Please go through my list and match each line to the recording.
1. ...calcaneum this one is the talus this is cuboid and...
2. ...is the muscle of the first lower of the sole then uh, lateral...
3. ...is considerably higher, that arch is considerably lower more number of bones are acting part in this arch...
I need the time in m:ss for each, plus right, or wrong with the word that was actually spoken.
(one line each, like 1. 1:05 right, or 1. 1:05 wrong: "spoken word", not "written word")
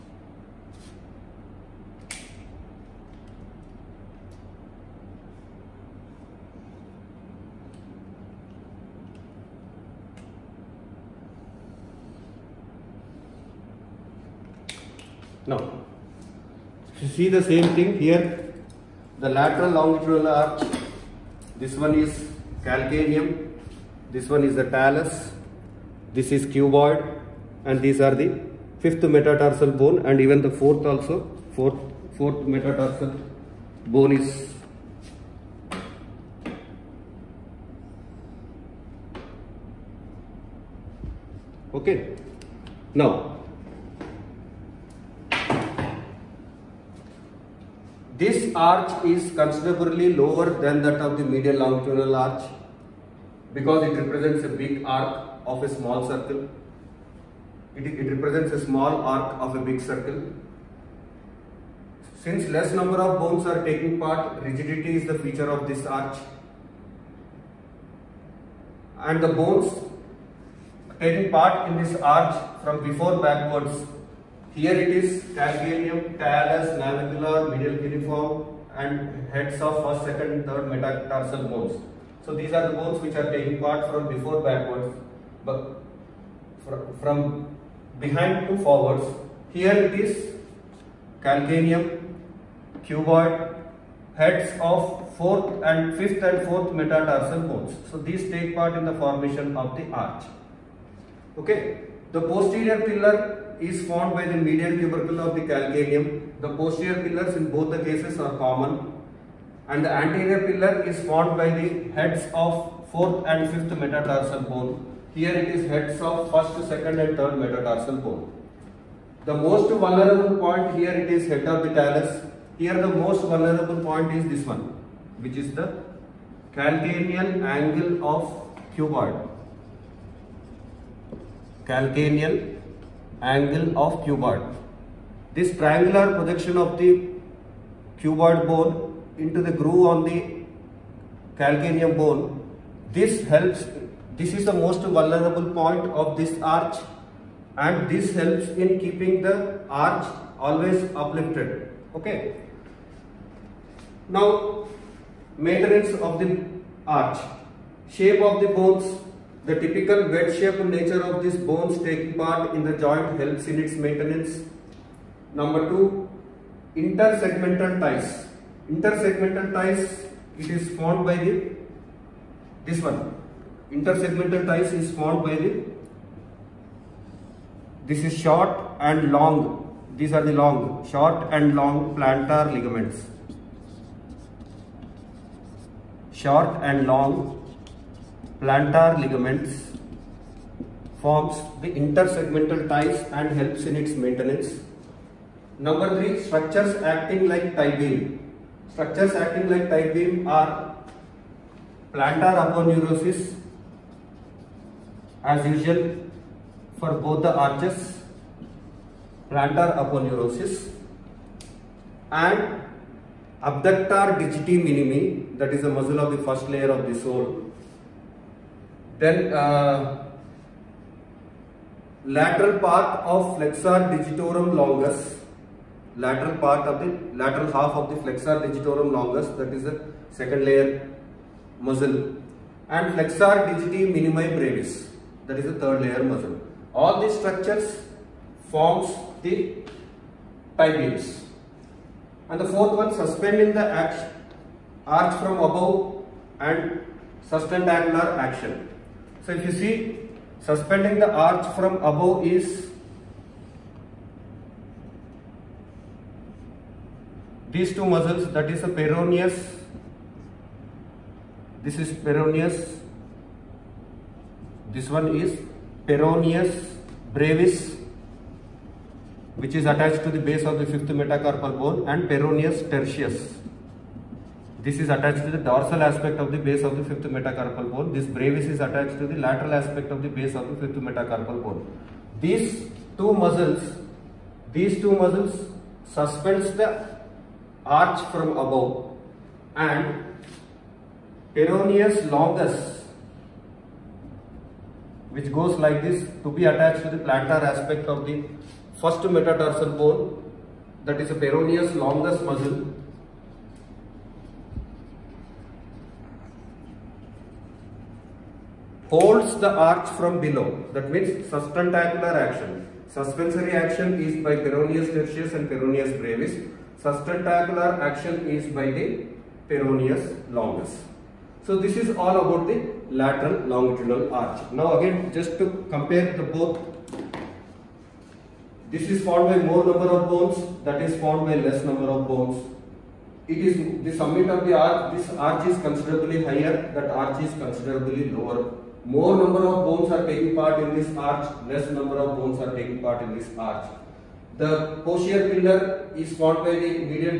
1. 0:22 right
2. 3:35 wrong: "layer", not "lower"
3. 5:35 wrong: "taking", not "acting".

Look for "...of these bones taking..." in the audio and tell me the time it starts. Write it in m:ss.
2:41.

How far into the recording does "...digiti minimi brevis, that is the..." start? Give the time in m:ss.
3:53.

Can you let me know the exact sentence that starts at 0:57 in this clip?
It, it represents a small arc of a big circle.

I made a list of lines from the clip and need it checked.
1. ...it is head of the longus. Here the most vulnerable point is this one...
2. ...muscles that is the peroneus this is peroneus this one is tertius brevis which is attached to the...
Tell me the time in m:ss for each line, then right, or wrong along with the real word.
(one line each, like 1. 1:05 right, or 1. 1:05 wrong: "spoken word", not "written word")
1. 2:00 wrong: "talus", not "longus"
2. 4:17 wrong: "peroneus", not "tertius".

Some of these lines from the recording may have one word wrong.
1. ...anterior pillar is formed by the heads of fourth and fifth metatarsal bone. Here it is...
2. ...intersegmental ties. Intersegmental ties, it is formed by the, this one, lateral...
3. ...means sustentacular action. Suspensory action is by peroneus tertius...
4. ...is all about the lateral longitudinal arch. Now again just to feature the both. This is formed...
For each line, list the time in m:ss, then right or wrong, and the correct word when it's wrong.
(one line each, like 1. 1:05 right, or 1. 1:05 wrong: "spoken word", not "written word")
1. 1:49 right
2. 2:46 wrong: "intersegmental", not "lateral"
3. 5:10 right
4. 5:21 wrong: "compare", not "feature".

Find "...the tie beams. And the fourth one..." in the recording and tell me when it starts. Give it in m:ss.
3:59.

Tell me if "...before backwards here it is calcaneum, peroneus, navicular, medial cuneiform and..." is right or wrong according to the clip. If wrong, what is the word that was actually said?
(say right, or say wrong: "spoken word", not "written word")
wrong: "talus", not "peroneus".